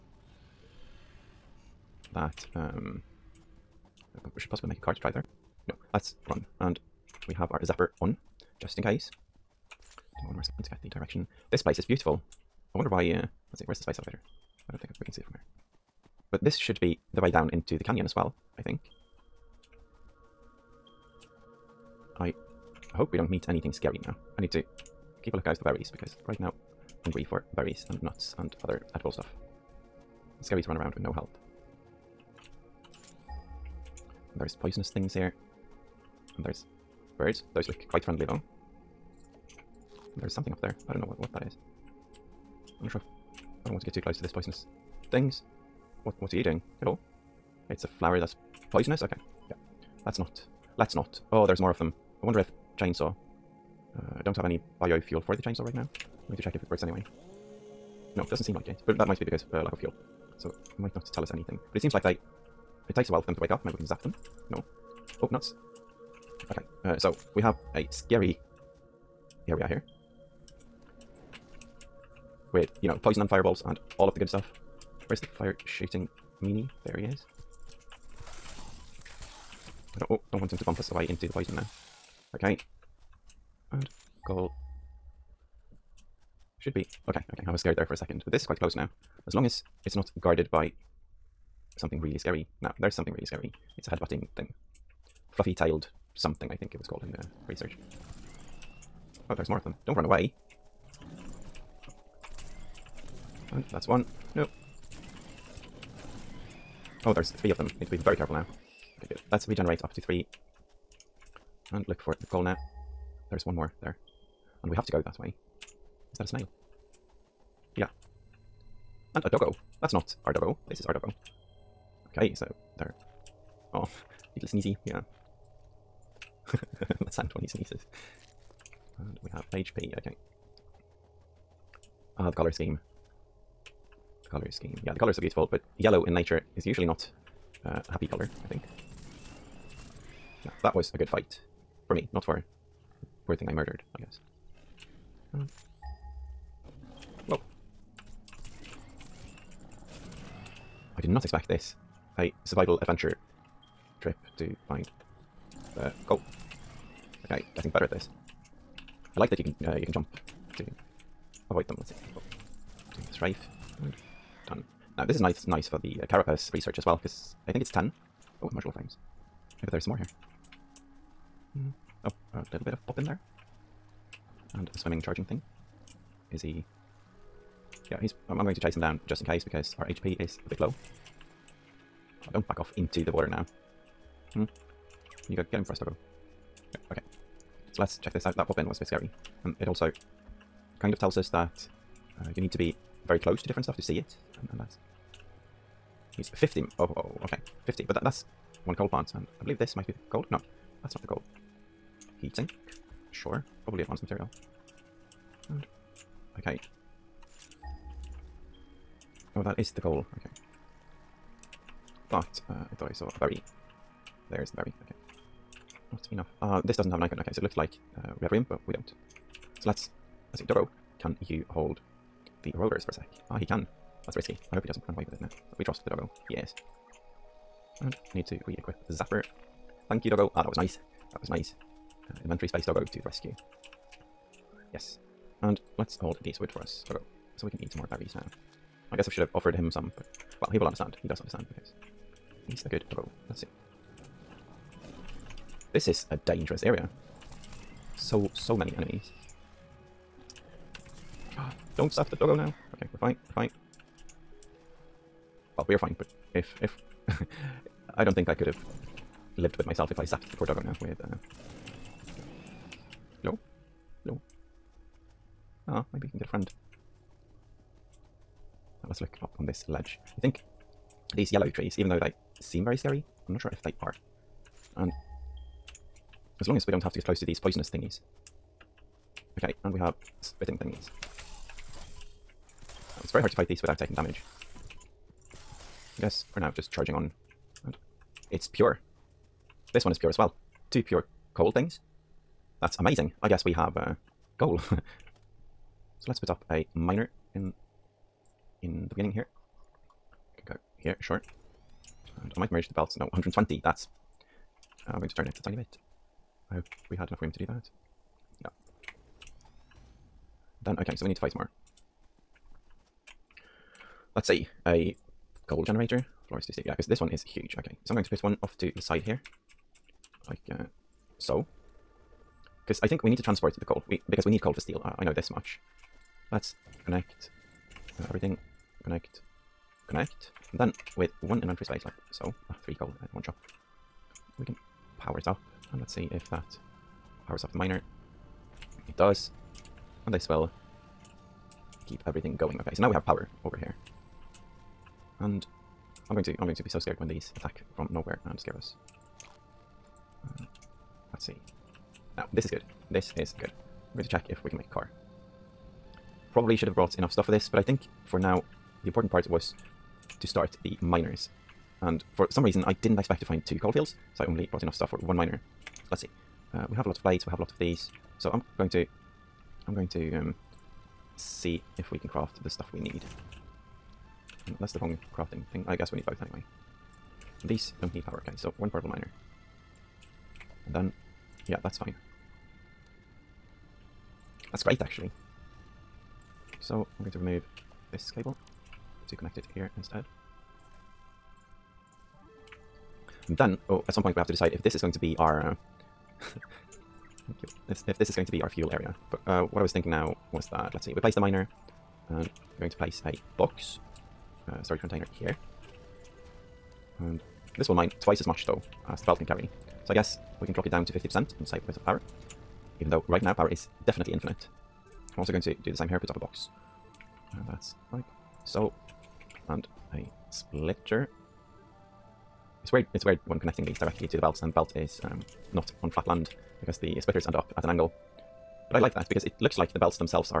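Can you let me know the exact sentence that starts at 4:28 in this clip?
let's look up on this ledge.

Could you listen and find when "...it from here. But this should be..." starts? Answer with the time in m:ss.
0:15.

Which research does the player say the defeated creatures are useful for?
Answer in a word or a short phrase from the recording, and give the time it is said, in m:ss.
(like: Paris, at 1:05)
carapace, at 2:46.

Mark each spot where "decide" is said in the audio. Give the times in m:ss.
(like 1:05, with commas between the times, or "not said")
6:34.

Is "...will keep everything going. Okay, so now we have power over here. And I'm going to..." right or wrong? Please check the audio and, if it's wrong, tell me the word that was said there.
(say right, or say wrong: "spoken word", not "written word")
right.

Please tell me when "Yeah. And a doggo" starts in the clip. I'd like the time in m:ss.
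1:57.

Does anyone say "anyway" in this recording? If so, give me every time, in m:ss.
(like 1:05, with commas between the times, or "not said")
0:56, 6:16.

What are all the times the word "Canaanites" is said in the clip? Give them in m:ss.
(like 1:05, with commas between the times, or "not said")
not said.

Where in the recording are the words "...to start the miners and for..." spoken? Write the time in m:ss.
6:00.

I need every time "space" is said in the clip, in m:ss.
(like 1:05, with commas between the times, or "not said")
0:13, 3:52, 5:31.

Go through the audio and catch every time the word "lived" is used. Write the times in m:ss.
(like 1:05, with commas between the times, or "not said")
4:19.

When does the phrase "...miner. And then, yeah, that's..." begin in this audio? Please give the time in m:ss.
6:18.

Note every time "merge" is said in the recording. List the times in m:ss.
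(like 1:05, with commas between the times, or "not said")
5:02.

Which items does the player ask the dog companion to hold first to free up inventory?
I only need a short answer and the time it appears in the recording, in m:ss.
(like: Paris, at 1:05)
rotors, at 3:42.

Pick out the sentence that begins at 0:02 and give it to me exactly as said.
Um, we should possibly make a car to drive there.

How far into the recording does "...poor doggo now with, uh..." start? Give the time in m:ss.
4:20.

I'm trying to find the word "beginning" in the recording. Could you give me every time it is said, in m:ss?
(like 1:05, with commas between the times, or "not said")
4:58.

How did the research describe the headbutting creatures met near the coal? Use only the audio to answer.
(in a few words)
fluffy tailed.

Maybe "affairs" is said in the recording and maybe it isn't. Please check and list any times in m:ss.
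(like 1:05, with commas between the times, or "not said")
not said.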